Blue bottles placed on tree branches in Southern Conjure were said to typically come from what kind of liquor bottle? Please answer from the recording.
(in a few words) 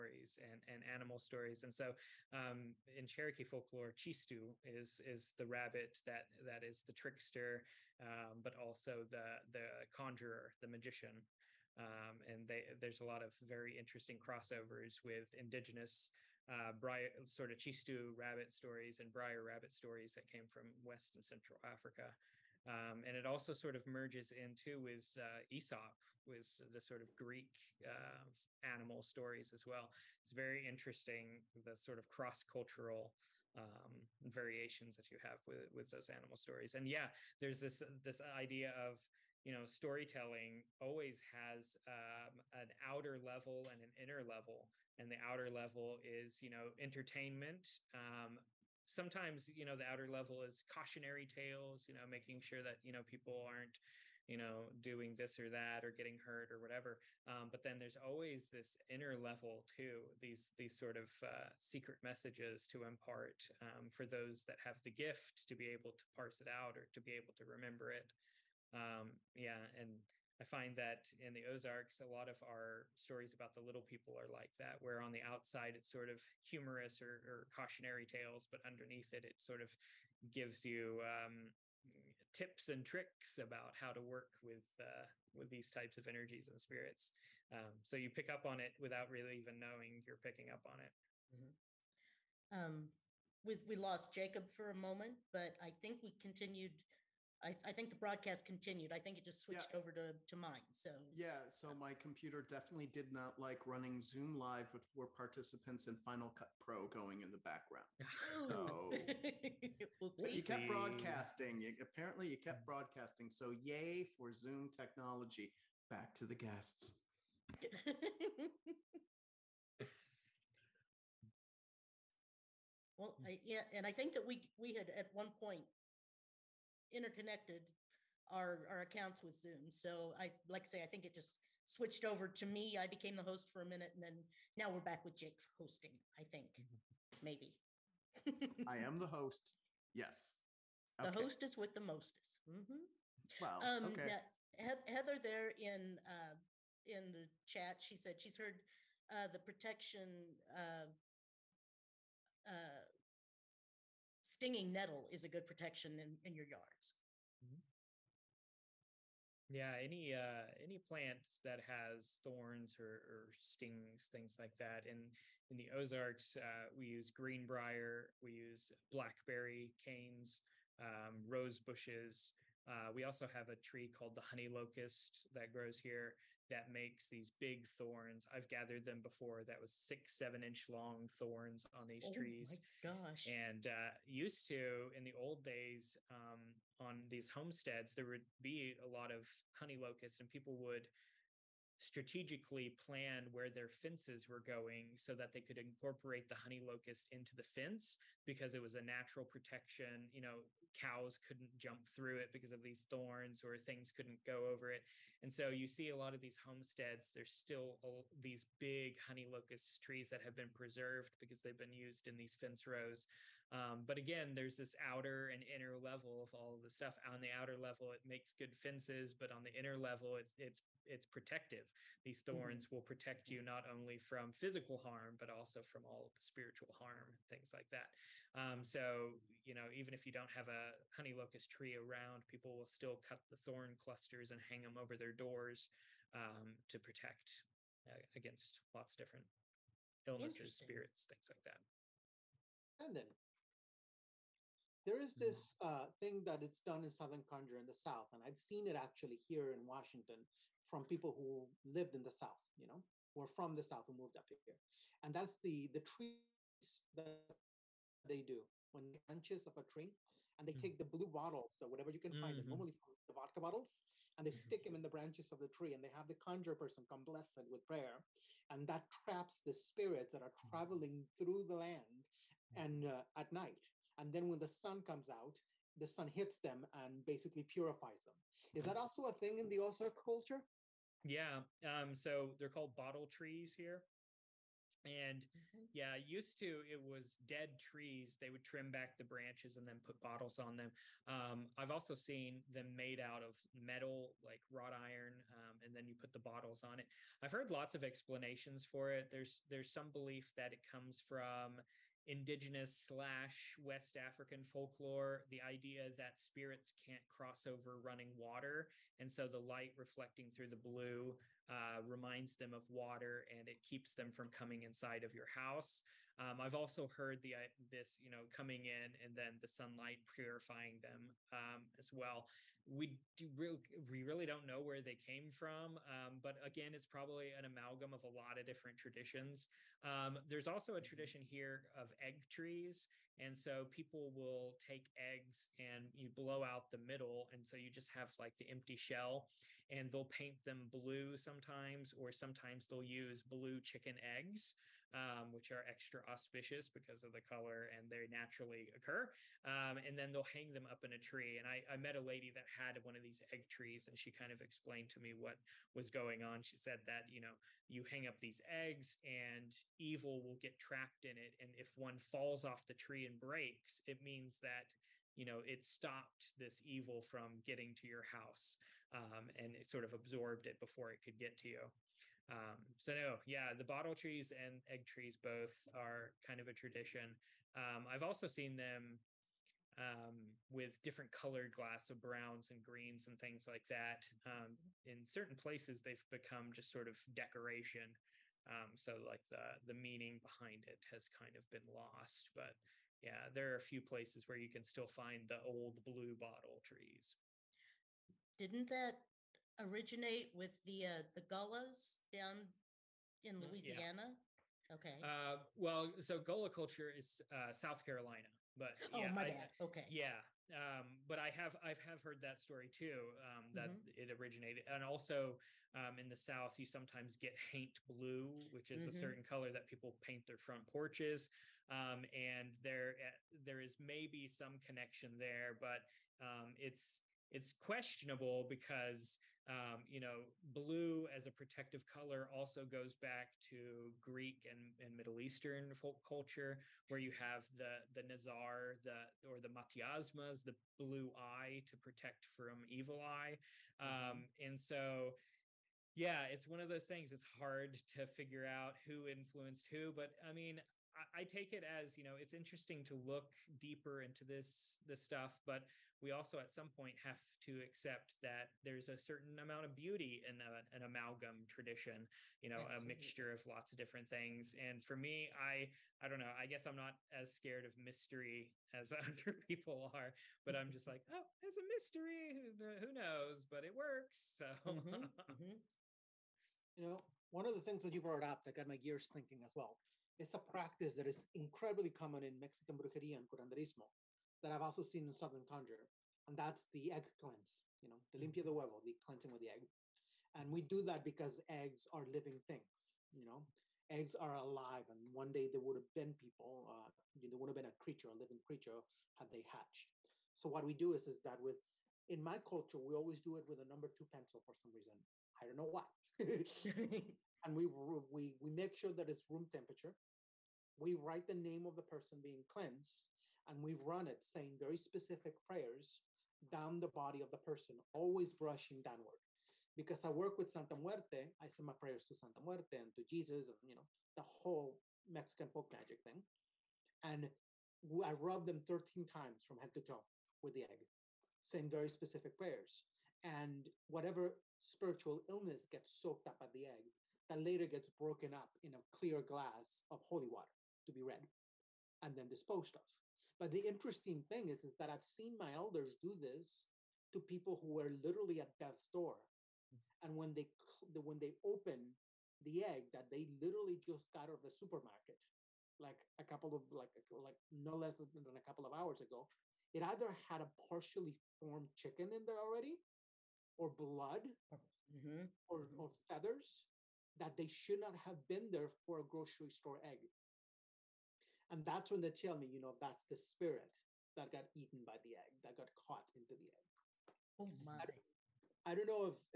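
Vodka.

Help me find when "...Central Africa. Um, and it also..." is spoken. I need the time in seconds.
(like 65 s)
21 s.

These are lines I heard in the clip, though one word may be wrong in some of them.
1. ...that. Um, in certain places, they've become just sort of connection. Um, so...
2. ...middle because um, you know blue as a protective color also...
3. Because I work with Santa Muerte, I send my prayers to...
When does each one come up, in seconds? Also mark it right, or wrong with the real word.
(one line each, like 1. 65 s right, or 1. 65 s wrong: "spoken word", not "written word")
1. 383 s wrong: "decoration", not "connection"
2. 427 s wrong: "questionable", not "middle"
3. 519 s right.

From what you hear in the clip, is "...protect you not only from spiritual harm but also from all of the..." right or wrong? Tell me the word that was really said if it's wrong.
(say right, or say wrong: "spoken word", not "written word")
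wrong: "physical", not "spiritual".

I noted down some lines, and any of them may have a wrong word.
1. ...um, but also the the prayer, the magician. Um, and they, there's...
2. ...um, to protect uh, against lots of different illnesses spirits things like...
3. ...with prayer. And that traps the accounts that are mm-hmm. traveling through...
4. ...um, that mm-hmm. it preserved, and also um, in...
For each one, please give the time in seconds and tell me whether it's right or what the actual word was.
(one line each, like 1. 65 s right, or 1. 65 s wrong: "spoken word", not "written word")
1. 7 s wrong: "conjurer", not "prayer"
2. 236 s right
3. 267 s wrong: "spirits", not "accounts"
4. 413 s wrong: "originated", not "preserved".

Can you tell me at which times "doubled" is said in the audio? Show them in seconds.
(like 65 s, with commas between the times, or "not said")
not said.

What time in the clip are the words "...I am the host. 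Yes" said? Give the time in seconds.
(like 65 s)
138 s.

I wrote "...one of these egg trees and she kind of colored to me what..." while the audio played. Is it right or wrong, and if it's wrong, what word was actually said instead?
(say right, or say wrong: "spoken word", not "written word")
wrong: "explained", not "colored".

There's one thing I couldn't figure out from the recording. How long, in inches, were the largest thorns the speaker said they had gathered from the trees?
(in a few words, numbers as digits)
6-7 inches.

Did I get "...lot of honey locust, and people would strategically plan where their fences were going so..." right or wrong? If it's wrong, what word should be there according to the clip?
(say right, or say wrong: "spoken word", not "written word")
right.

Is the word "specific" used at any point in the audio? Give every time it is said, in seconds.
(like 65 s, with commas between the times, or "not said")
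514 s, 531 s.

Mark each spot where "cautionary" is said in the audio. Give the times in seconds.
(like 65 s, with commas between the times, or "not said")
50 s, 77 s.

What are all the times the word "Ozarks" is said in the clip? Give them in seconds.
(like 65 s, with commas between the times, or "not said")
71 s, 165 s, 279 s.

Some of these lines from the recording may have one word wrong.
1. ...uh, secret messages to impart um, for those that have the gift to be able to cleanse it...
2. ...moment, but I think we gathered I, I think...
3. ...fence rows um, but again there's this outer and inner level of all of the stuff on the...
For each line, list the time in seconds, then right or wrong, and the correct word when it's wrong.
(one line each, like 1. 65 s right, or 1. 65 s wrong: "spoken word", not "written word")
1. 61 s wrong: "parse", not "cleanse"
2. 94 s wrong: "continued", not "gathered"
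3. 212 s right.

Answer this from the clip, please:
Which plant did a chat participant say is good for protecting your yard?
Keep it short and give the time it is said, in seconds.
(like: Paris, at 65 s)
Stinging nettle, at 154 s.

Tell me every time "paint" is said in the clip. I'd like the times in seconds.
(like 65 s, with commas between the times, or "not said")
340 s, 420 s.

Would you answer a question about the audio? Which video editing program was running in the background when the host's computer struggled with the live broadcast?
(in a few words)
Final Cut Pro.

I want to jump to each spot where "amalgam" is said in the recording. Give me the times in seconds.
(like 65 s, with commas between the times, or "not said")
327 s, 460 s.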